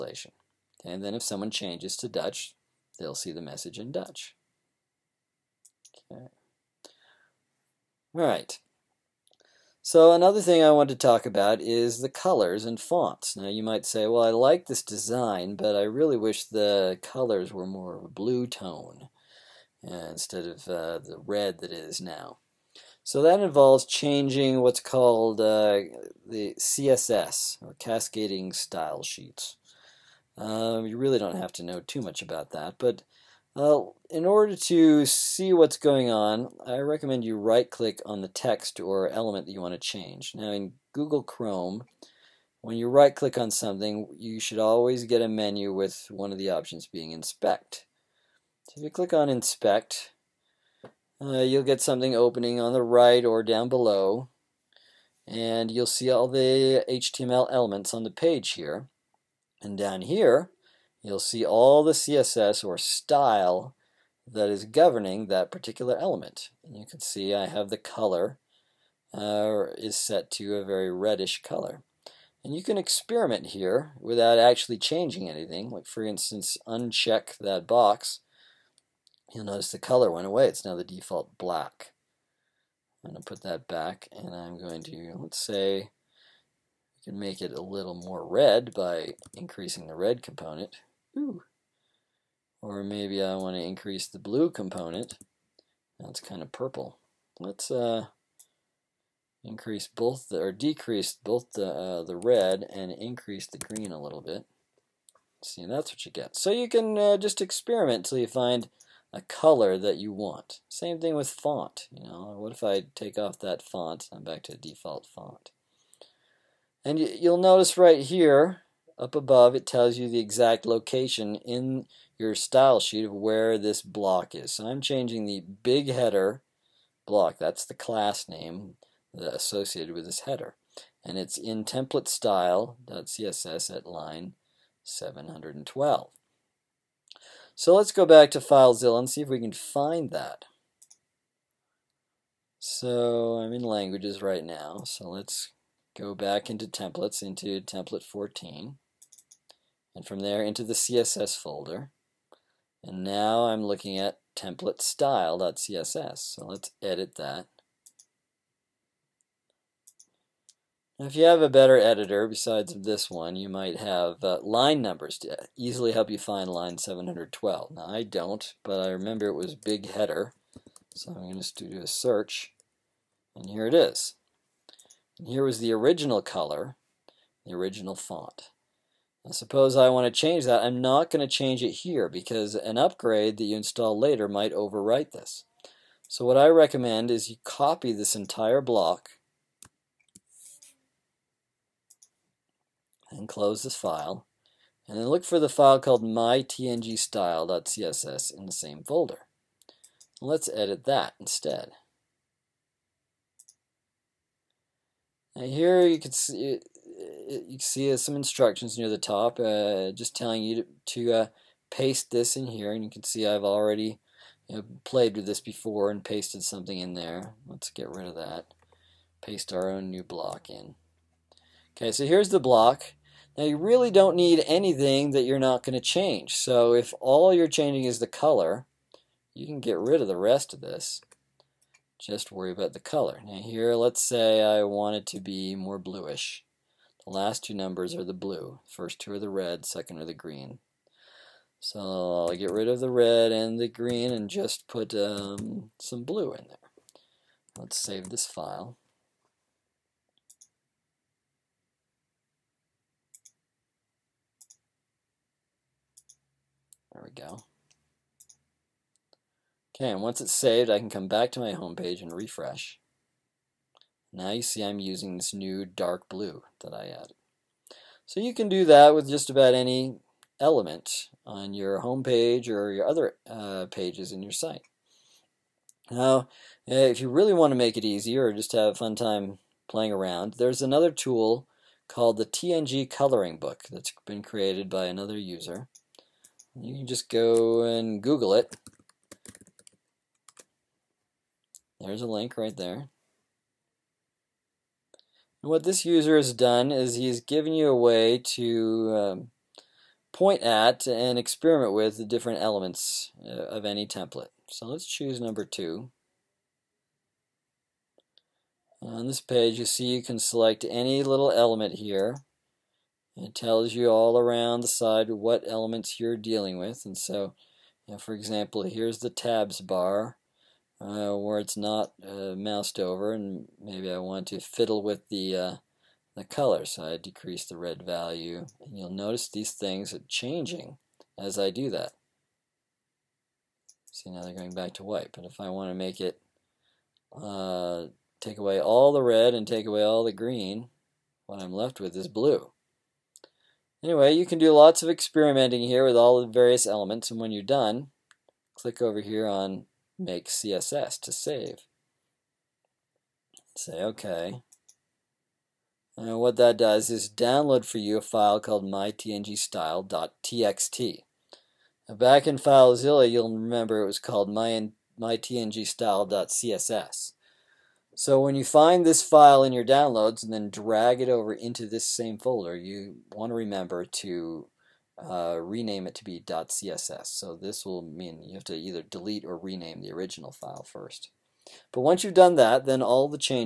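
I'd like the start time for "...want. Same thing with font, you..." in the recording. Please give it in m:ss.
1:50.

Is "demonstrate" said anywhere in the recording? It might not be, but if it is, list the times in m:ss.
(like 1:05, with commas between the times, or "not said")
not said.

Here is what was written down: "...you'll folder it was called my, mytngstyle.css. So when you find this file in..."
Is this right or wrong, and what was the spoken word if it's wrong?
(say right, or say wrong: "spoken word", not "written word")
wrong: "remember", not "folder".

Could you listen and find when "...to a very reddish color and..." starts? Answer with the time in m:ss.
1:10.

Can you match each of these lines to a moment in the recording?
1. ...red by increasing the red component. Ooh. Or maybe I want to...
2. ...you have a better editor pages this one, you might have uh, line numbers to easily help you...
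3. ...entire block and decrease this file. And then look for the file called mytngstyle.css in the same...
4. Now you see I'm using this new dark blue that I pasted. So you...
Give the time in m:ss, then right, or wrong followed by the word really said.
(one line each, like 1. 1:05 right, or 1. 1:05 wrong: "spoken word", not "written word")
1. 1:28 right
2. 2:41 wrong: "besides", not "pages"
3. 3:08 wrong: "close", not "decrease"
4. 4:24 wrong: "added", not "pasted".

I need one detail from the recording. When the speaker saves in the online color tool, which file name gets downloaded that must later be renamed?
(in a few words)
mytngstyle.txt.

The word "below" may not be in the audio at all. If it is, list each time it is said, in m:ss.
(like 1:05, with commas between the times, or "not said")
0:53.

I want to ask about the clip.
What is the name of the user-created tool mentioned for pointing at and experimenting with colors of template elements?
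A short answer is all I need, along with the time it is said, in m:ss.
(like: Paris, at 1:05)
TNG Coloring Book, at 4:42.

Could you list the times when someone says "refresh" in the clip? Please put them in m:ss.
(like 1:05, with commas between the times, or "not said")
4:22.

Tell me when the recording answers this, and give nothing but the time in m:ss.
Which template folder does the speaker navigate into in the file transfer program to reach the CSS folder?
2:27.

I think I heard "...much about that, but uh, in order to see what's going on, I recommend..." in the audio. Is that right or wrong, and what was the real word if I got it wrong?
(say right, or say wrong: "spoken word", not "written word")
right.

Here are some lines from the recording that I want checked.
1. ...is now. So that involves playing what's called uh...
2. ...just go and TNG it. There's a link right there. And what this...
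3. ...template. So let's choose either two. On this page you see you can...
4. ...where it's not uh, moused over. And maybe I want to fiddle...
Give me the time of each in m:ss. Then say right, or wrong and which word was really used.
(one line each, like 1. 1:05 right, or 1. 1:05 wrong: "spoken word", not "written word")
1. 0:21 wrong: "changing", not "playing"
2. 4:46 wrong: "Google", not "TNG"
3. 5:03 wrong: "number", not "either"
4. 5:21 right.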